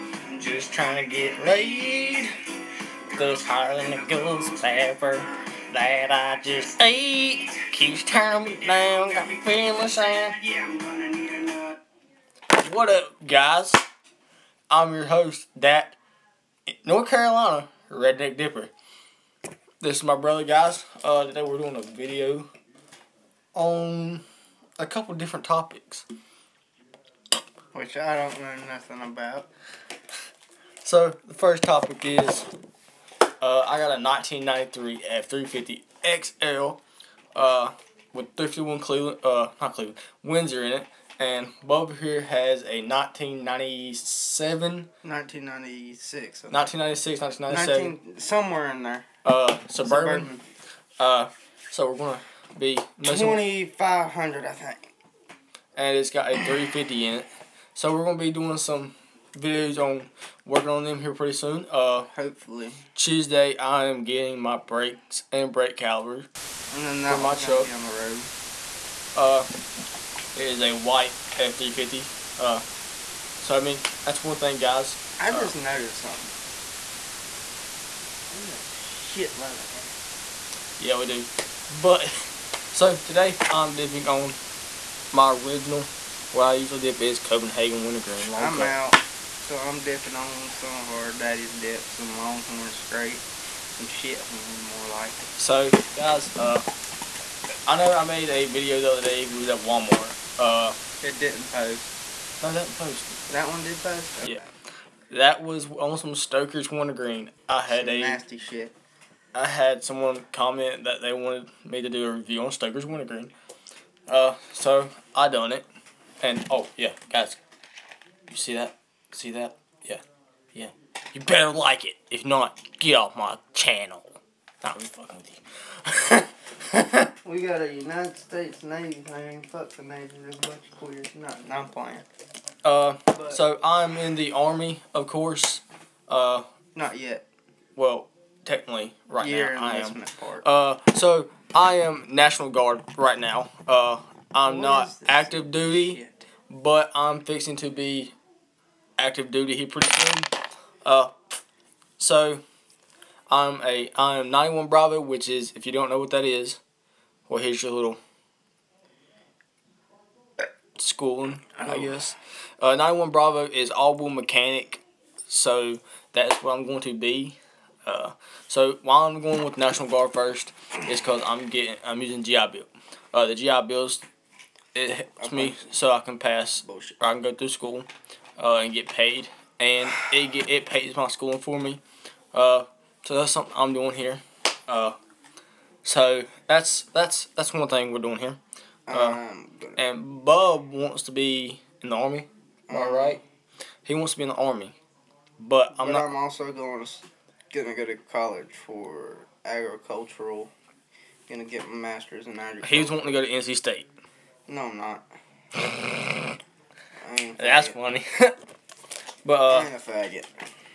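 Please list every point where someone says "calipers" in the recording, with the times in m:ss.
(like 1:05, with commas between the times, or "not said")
1:05.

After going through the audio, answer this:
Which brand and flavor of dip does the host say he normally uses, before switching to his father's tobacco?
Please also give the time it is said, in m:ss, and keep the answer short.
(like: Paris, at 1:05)
Copenhagen wintergreen, at 1:27.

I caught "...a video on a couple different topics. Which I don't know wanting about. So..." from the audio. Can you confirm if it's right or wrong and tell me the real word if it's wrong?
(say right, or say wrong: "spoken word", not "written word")
wrong: "nothing", not "wanting".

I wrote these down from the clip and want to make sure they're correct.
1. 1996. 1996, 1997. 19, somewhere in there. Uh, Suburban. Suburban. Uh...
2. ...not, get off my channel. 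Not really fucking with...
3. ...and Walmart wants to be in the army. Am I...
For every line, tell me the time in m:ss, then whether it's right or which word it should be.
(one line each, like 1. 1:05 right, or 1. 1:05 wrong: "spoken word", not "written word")
1. 0:45 right
2. 2:02 right
3. 3:09 wrong: "Bub", not "Walmart".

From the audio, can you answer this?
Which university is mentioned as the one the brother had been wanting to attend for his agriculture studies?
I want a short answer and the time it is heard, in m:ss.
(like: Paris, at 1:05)
NC State, at 3:23.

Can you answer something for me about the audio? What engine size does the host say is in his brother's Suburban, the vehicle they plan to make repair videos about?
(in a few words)
350.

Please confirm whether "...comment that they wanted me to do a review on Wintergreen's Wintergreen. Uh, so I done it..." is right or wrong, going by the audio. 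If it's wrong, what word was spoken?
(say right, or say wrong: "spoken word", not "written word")
wrong: "Stoker", not "Wintergreen".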